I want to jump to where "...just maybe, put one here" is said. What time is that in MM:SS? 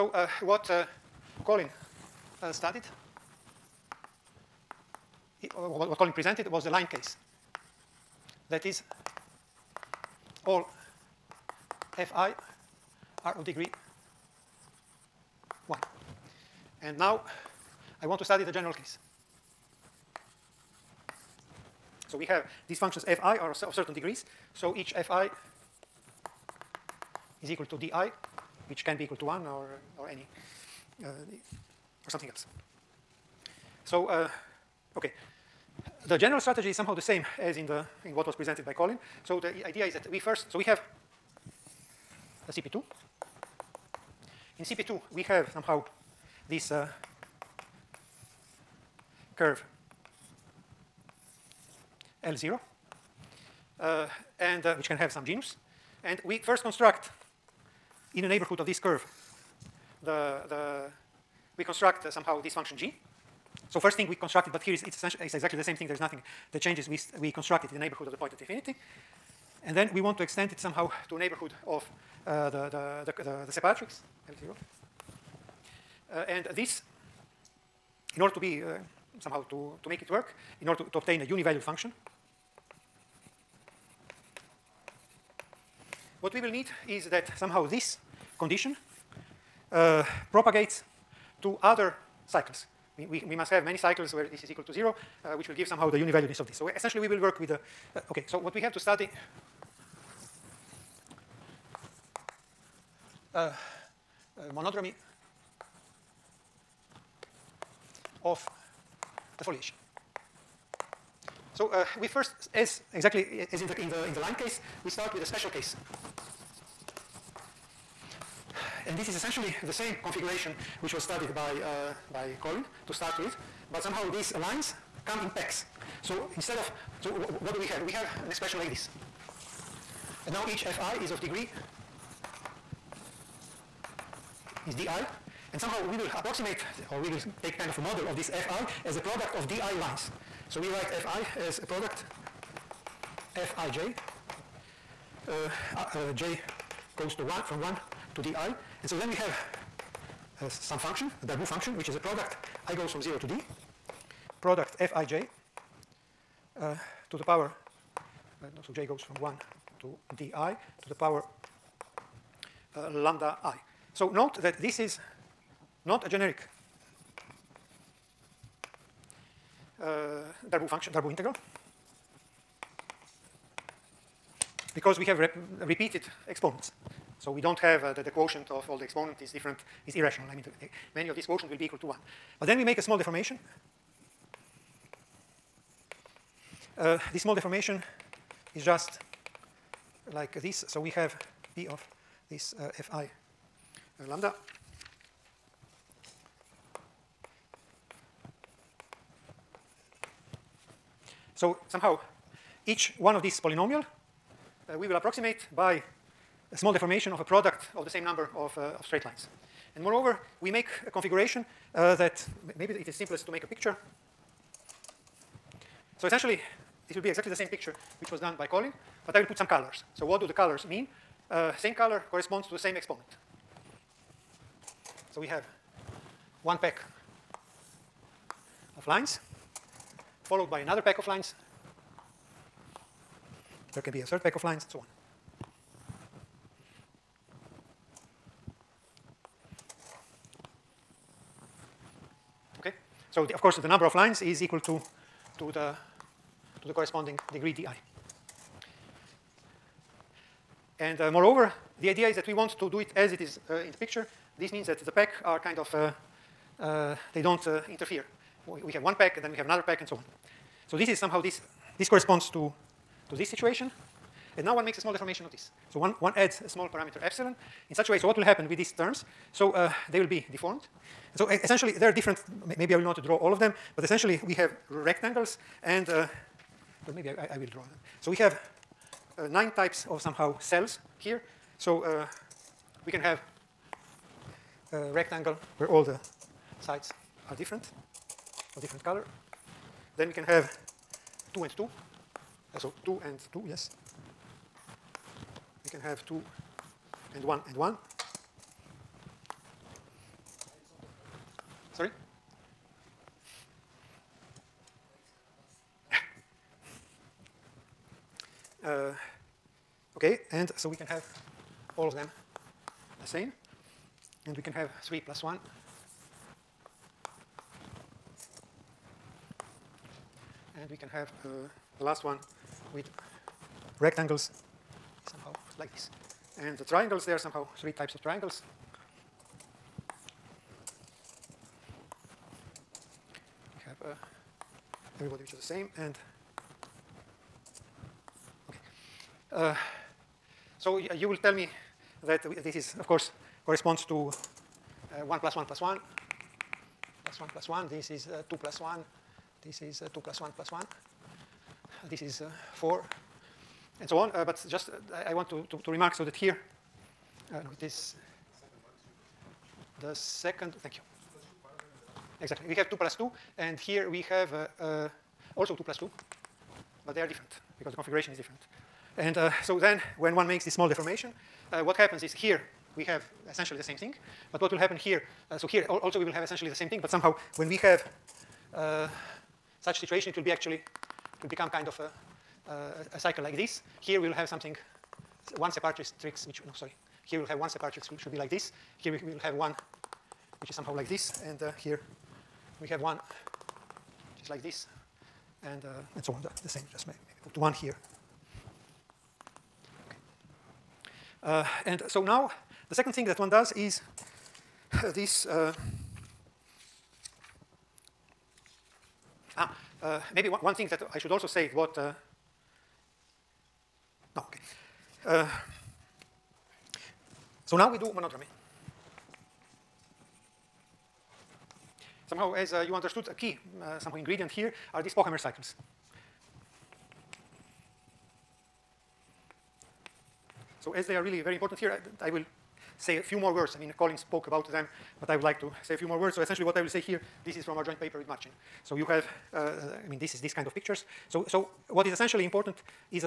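06:36.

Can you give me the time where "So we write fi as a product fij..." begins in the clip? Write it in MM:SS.
02:20.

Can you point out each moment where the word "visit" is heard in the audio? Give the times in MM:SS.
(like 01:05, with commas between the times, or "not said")
not said.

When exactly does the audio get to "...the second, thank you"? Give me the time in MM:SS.
05:59.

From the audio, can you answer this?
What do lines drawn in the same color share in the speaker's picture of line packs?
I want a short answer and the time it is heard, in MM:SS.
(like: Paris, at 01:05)
the same exponent, at 03:42.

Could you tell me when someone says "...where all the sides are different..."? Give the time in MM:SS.
04:45.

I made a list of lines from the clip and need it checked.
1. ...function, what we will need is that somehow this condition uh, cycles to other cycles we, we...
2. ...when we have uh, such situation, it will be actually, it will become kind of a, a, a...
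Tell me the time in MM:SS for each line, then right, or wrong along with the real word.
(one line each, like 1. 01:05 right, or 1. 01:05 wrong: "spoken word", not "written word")
1. 01:21 wrong: "propagates", not "cycles"
2. 06:17 right.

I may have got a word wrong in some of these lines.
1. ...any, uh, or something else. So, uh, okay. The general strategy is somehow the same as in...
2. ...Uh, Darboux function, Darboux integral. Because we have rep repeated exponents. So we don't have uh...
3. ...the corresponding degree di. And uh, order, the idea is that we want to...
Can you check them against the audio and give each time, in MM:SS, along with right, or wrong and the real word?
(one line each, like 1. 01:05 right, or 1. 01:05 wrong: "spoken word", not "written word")
1. 00:30 right
2. 02:49 right
3. 04:06 wrong: "moreover", not "order".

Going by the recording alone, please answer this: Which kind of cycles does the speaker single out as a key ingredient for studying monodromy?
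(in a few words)
Pochhammer cycles.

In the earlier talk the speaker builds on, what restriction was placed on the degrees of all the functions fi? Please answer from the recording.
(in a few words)
degree 1.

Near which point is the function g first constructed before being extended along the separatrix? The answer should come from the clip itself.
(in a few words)
the point at infinity.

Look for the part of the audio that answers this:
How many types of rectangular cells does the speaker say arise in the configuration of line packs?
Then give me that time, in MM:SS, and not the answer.
04:39.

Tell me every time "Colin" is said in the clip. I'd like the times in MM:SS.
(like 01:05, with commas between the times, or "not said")
00:01, 00:05, 00:38, 02:02, 03:38, 07:13.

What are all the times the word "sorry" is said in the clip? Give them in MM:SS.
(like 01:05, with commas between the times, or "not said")
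05:01, 06:26.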